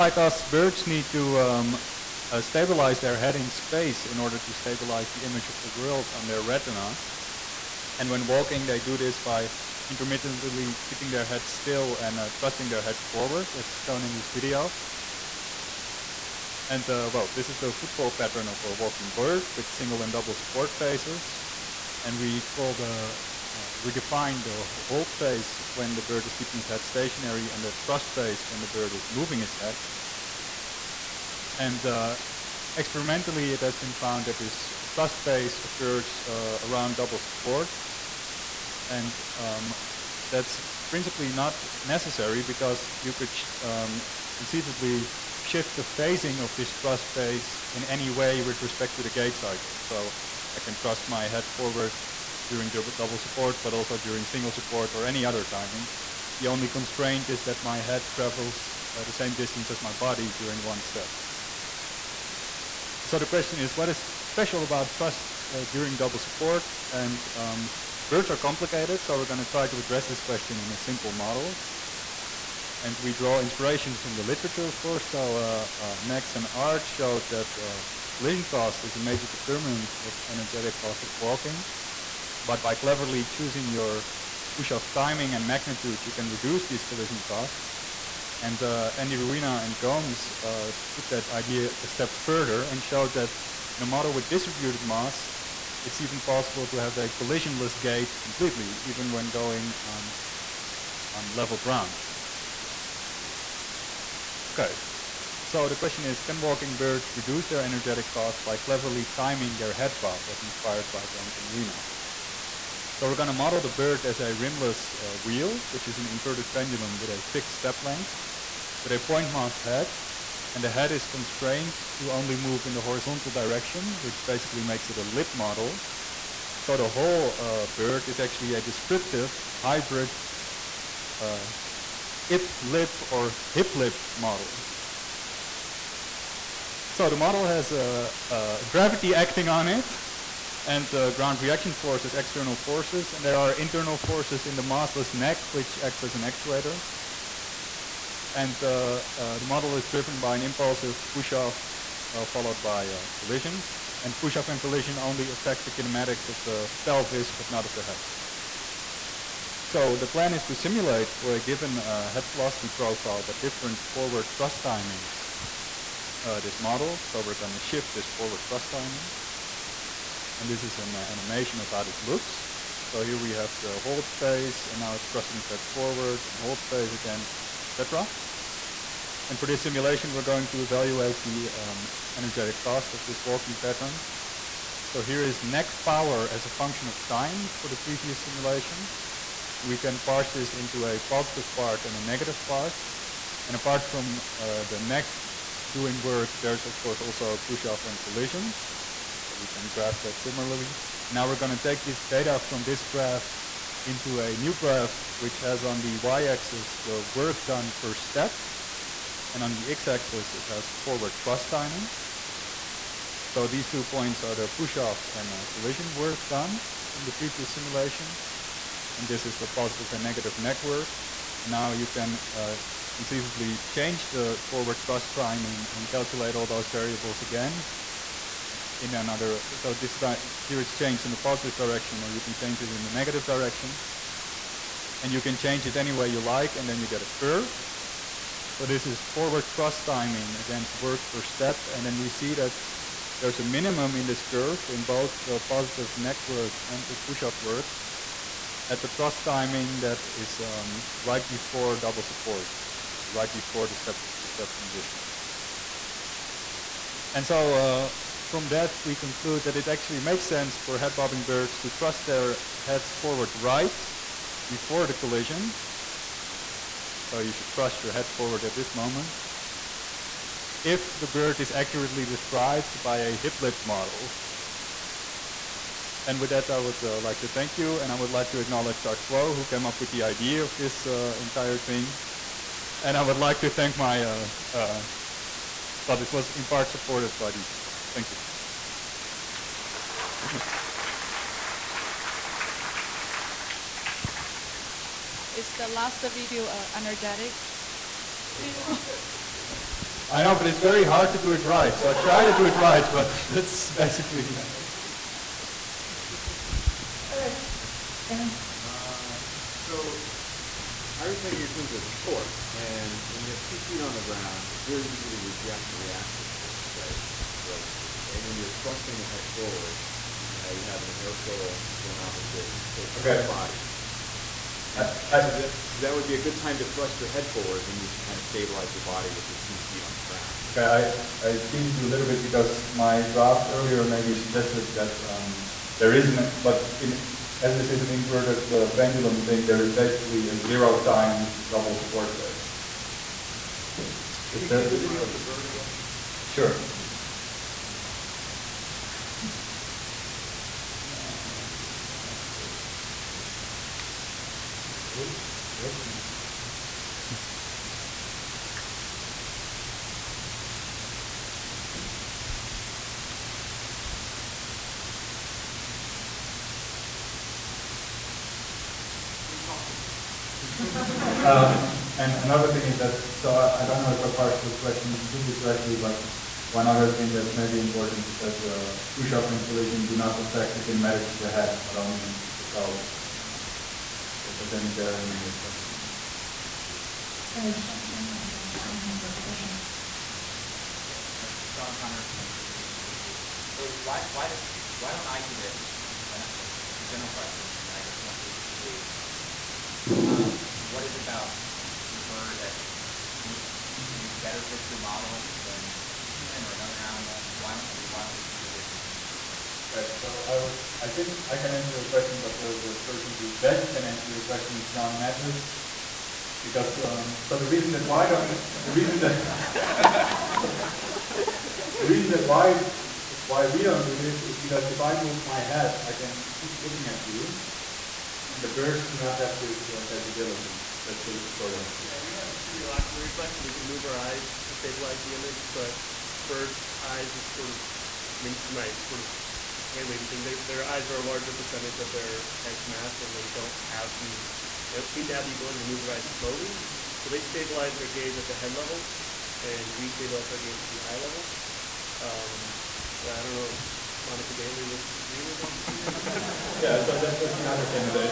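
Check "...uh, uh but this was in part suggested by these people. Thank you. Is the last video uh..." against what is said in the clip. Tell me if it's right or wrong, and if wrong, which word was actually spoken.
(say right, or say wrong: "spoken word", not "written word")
wrong: "supported", not "suggested".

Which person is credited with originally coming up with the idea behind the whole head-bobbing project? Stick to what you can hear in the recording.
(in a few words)
Art Kuo.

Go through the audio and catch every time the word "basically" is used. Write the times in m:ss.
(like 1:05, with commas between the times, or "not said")
2:04, 5:03, 5:39.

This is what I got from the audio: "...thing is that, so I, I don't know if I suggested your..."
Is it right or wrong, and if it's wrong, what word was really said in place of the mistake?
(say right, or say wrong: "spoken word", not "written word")
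wrong: "parsed", not "suggested".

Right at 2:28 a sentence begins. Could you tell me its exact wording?
And uh, uh, the model is driven by an impulsive push-off uh, followed by a collision.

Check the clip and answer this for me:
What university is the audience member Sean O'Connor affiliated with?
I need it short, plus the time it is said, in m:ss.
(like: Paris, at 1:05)
San Diego State University, at 6:32.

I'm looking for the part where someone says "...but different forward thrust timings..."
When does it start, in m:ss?
2:43.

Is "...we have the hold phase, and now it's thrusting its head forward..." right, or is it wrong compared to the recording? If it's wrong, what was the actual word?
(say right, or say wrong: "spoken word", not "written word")
right.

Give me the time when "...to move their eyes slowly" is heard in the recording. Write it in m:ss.
7:25.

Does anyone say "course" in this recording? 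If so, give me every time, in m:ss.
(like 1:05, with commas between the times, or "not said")
1:14, 3:16.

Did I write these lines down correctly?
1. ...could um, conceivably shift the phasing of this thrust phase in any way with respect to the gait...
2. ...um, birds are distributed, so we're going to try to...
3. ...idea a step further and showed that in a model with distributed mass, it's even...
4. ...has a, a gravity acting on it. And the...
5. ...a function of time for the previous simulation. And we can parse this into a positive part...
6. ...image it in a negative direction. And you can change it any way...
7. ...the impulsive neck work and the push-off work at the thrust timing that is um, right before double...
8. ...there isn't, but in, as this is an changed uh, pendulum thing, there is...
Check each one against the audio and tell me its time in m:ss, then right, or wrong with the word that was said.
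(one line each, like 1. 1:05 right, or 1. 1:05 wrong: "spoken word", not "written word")
1. 0:43 right
2. 1:07 wrong: "complicated", not "distributed"
3. 1:31 right
4. 2:17 right
5. 3:06 right
6. 3:52 wrong: "change", not "image"
7. 4:05 wrong: "positive", not "impulsive"
8. 5:35 wrong: "inverted", not "changed".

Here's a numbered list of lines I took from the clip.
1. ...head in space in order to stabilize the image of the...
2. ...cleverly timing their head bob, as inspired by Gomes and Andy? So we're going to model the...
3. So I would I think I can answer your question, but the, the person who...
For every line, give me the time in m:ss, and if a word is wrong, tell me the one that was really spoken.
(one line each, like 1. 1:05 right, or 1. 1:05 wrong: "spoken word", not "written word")
1. 0:03 right
2. 1:48 wrong: "Ruina", not "Andy"
3. 6:50 right.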